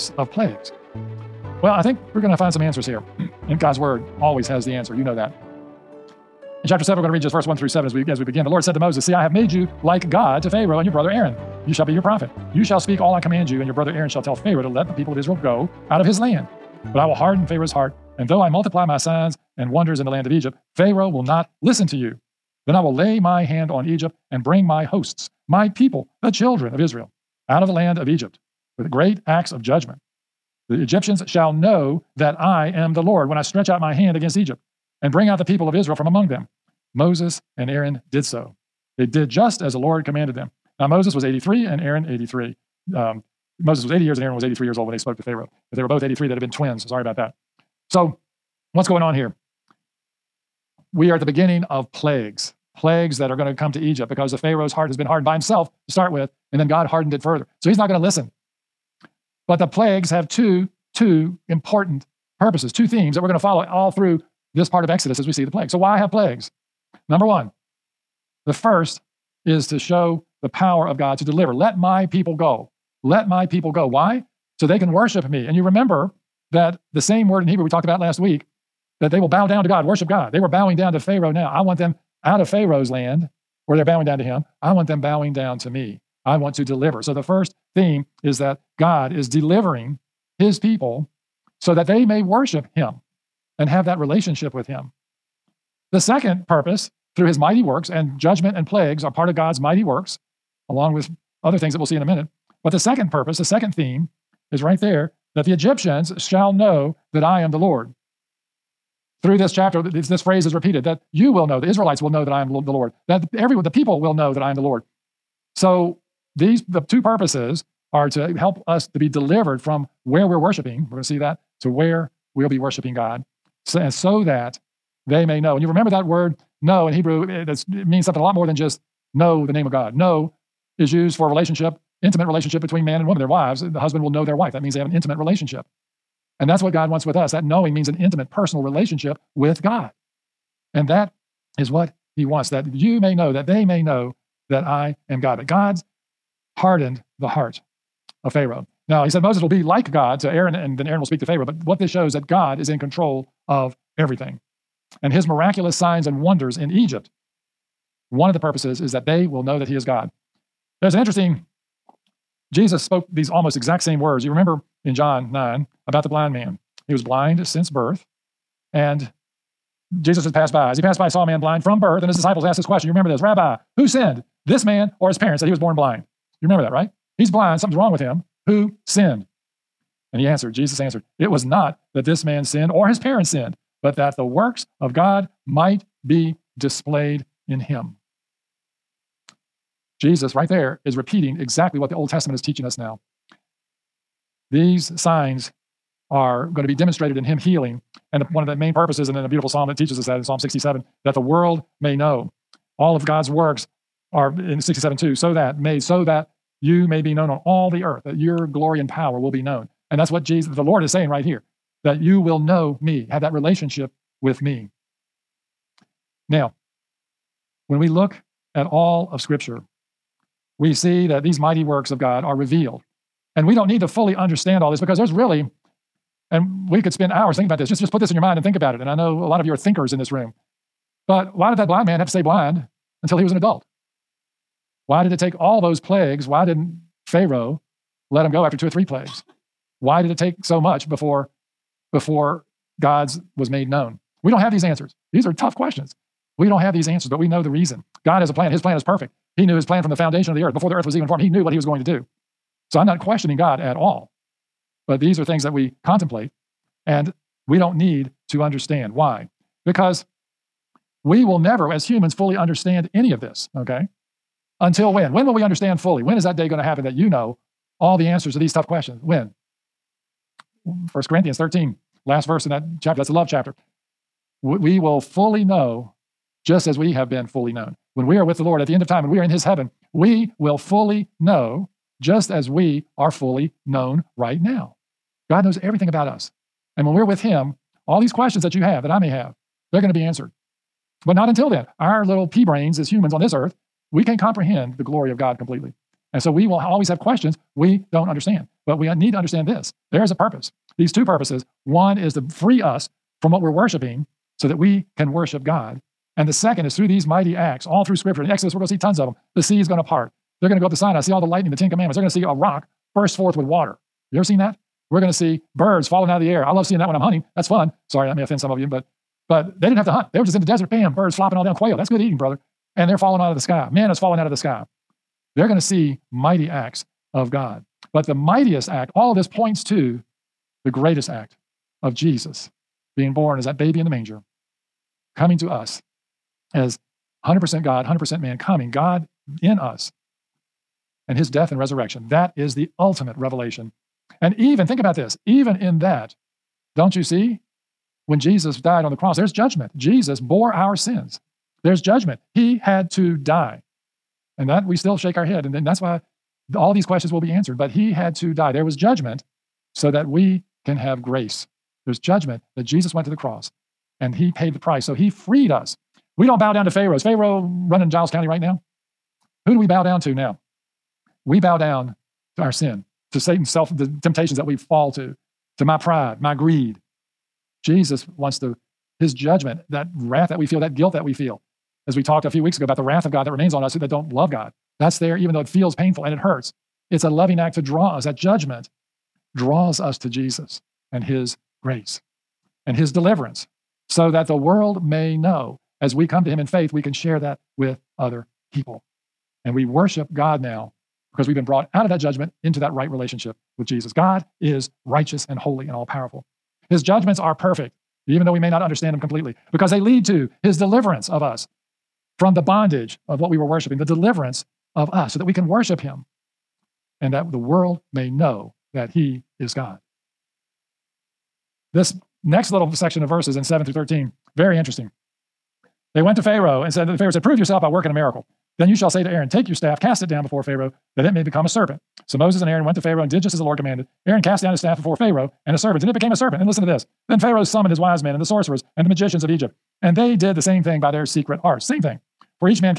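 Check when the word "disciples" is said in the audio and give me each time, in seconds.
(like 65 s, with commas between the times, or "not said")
172 s.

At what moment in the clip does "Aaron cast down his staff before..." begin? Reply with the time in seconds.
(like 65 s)
434 s.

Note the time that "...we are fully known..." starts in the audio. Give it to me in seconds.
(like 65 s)
282 s.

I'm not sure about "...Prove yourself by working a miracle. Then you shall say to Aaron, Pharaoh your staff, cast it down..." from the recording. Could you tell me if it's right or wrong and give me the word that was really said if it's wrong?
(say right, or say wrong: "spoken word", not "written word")
wrong: "Take", not "Pharaoh".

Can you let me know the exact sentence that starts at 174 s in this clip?
this man or his parents that he was born blind.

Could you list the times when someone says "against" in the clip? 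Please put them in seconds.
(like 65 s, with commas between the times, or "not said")
34 s.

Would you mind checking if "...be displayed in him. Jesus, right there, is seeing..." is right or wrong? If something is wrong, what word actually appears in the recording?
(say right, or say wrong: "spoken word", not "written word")
wrong: "repeating", not "seeing".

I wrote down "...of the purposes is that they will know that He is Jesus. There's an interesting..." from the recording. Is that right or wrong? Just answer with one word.
wrong.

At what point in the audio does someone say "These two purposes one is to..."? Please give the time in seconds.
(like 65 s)
300 s.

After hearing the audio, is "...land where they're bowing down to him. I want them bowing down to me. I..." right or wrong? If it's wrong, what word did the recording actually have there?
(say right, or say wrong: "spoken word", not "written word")
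right.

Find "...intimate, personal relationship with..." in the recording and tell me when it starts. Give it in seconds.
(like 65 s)
137 s.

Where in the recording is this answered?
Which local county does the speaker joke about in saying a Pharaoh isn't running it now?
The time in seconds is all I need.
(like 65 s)
367 s.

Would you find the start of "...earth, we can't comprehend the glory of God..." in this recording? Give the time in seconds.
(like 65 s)
293 s.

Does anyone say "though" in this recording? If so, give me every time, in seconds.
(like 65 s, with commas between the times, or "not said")
18 s, 385 s, 408 s.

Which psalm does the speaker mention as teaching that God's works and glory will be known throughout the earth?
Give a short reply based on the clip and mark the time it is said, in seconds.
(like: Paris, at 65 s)
Psalm 67, at 200 s.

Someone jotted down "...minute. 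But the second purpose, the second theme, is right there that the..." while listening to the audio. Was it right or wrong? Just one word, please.
right.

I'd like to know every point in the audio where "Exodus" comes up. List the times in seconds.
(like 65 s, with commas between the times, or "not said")
64 s, 308 s.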